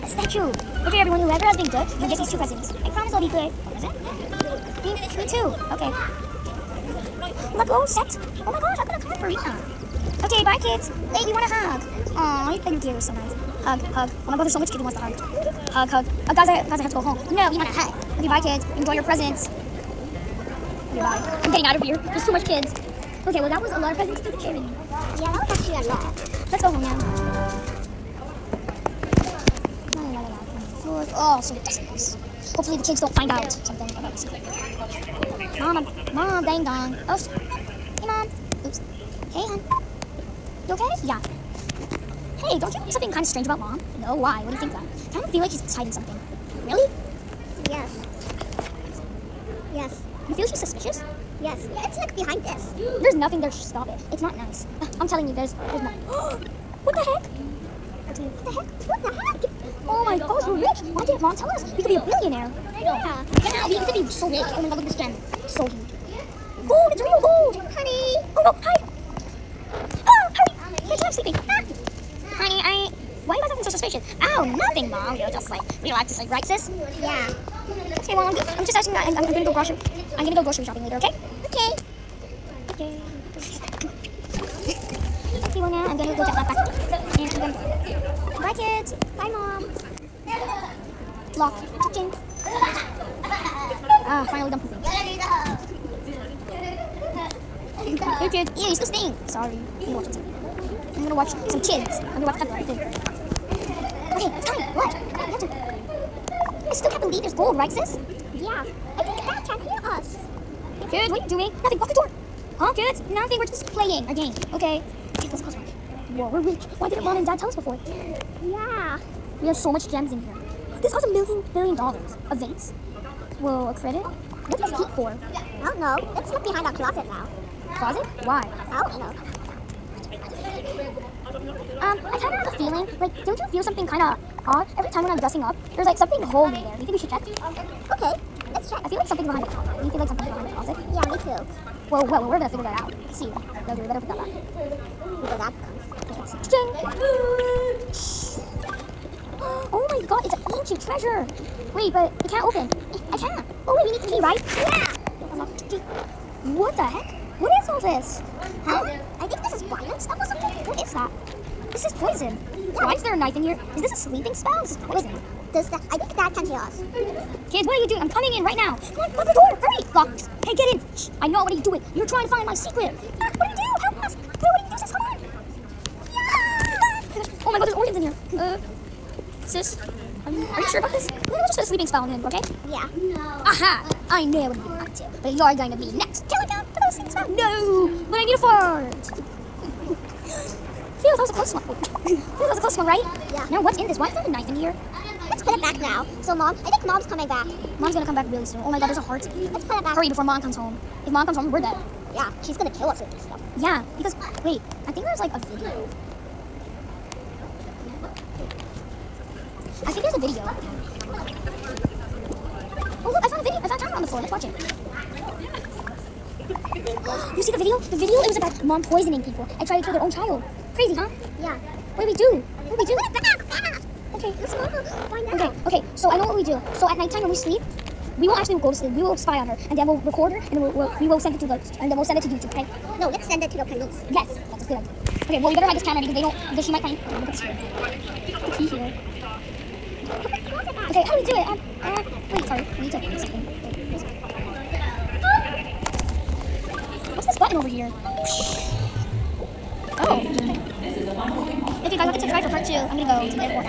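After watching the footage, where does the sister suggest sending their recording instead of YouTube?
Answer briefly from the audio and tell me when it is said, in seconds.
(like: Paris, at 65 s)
the police, at 233 s.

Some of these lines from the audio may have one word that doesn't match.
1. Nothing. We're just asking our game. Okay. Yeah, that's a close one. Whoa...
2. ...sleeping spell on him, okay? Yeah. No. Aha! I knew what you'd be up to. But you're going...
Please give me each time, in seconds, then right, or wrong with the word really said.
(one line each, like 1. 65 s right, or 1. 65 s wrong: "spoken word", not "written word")
1. 113 s wrong: "playing", not "asking"
2. 181 s right.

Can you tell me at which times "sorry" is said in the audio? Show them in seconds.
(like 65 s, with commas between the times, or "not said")
99 s, 242 s.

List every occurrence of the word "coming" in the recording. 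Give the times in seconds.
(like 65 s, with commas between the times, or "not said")
168 s, 197 s.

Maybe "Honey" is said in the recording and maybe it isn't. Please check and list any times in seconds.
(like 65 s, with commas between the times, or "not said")
67 s, 72 s.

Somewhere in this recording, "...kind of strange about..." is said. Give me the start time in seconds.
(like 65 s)
43 s.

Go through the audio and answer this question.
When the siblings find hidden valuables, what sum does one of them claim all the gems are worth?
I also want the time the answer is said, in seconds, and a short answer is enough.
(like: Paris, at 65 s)
a million billion dollars, at 121 s.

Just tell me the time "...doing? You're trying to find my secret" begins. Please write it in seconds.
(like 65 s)
171 s.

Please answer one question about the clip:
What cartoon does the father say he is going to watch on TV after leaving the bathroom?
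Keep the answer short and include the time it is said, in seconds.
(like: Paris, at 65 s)
Peppa, at 102 s.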